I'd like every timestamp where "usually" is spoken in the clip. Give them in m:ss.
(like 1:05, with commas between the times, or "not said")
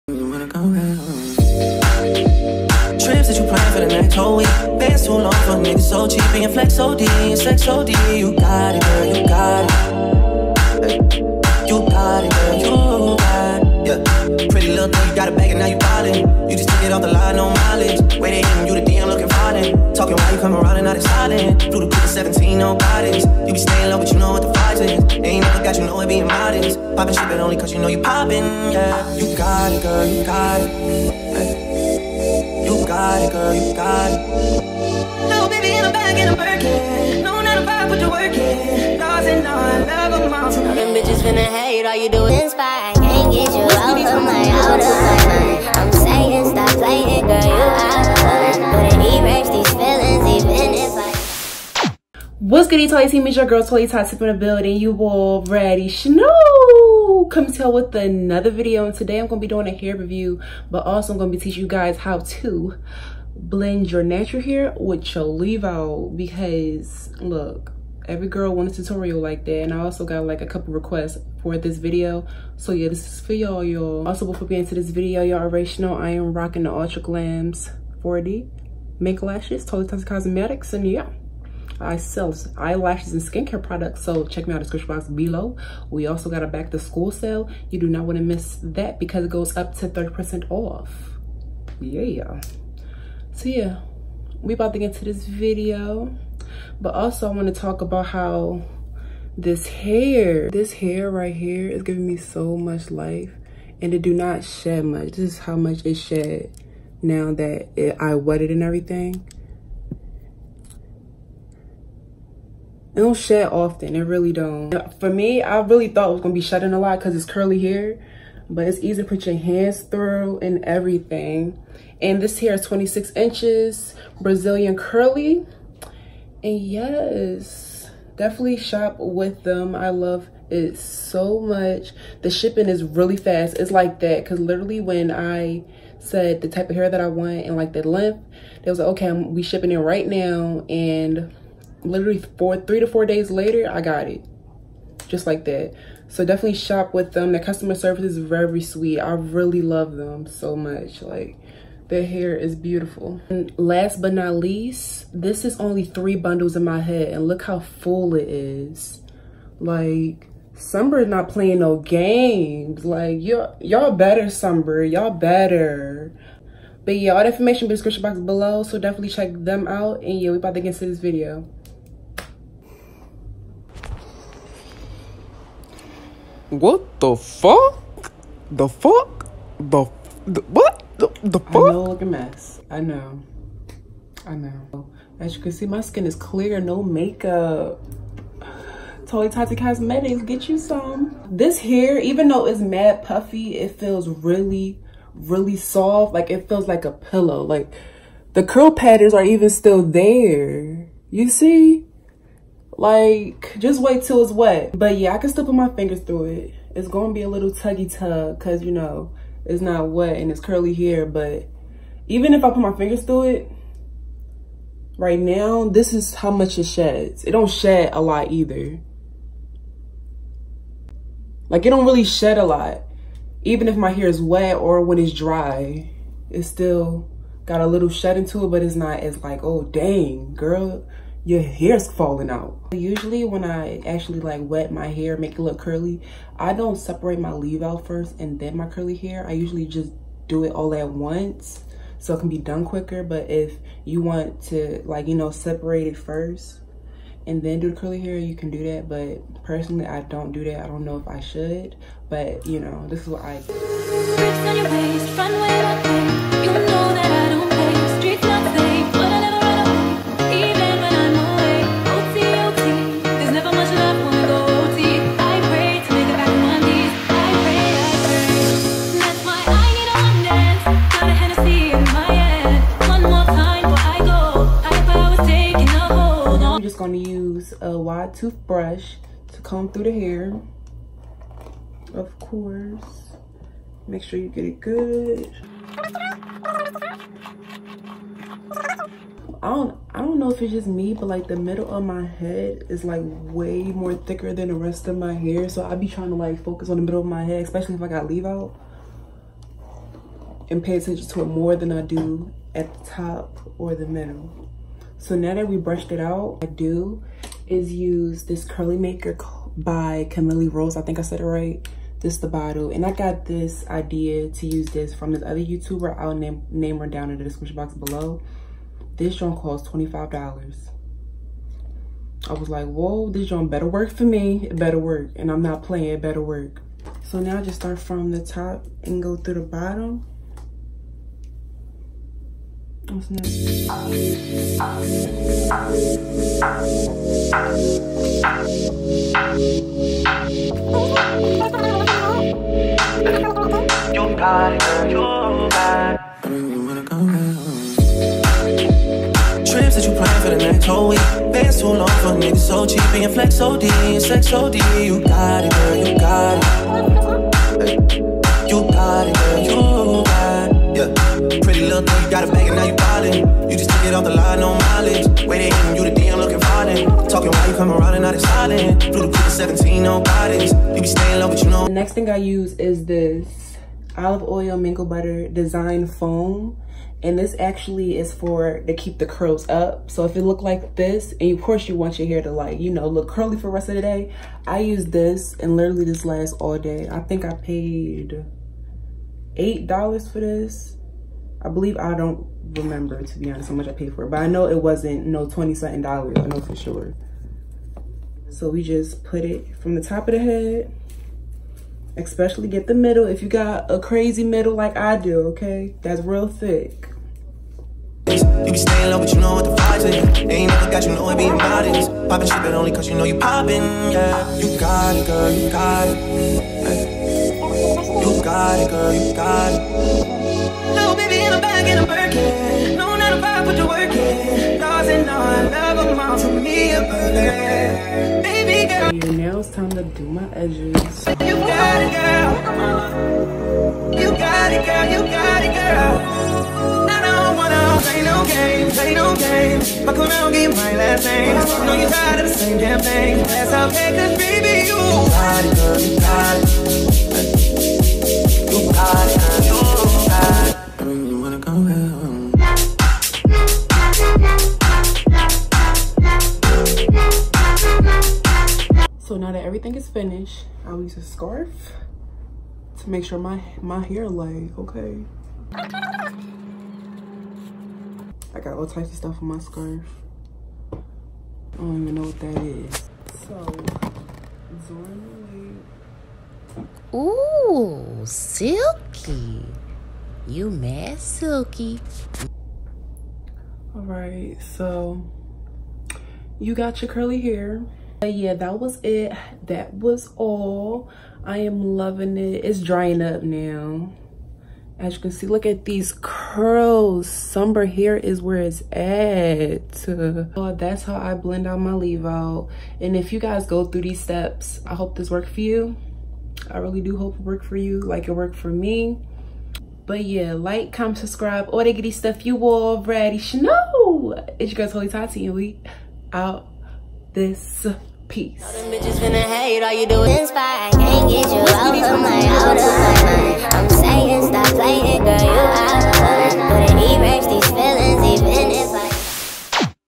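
3:52, 3:59.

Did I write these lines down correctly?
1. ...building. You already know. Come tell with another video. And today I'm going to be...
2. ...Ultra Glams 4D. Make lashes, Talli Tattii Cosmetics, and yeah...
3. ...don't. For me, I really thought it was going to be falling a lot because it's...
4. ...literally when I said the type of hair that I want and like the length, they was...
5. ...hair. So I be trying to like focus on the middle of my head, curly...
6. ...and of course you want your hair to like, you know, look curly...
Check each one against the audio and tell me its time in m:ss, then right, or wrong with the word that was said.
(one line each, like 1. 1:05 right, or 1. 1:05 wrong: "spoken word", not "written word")
1. 0:54 right
2. 1:16 right
3. 1:54 wrong: "shedding", not "falling"
4. 2:14 right
5. 4:55 wrong: "especially", not "curly"
6. 6:21 right.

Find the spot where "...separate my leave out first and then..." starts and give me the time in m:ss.
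3:56.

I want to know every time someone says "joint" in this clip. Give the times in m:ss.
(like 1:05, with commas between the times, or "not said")
5:19, 5:23.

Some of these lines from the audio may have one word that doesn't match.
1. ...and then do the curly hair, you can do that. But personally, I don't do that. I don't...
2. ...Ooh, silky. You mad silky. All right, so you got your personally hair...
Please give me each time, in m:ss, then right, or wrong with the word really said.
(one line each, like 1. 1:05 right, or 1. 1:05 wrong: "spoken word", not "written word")
1. 4:07 right
2. 7:56 wrong: "curly", not "personally".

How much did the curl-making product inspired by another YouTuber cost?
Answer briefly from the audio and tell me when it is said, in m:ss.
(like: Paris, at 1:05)
$25, at 5:19.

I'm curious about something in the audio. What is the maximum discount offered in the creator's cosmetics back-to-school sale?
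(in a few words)
30%.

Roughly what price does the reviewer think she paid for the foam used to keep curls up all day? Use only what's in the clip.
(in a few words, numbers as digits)
$8.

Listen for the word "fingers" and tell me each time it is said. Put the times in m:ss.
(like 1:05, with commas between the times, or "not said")
3:25, 3:32.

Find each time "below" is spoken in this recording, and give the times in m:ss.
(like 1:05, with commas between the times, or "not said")
1:25, 2:48, 5:17.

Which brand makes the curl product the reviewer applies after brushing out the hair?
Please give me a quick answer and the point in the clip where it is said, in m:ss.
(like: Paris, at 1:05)
Camille Rose, at 5:10.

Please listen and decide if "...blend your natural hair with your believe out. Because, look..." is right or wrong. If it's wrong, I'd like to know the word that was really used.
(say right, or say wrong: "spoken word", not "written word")
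wrong: "leave", not "believe".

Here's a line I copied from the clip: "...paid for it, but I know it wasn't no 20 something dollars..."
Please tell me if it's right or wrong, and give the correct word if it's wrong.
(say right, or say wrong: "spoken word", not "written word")
right.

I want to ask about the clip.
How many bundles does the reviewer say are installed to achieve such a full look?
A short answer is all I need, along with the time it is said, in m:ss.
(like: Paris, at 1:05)
3, at 2:35.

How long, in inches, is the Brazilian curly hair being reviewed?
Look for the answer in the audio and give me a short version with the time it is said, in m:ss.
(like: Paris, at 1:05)
26 inches, at 2:02.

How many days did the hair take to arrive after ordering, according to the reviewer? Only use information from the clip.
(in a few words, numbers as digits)
3 to 4 days.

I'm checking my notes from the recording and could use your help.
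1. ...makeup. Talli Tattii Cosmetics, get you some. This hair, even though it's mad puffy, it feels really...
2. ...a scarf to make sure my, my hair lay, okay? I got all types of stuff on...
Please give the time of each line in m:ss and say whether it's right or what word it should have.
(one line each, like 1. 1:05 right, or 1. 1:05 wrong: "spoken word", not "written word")
1. 3:06 right
2. 7:40 right.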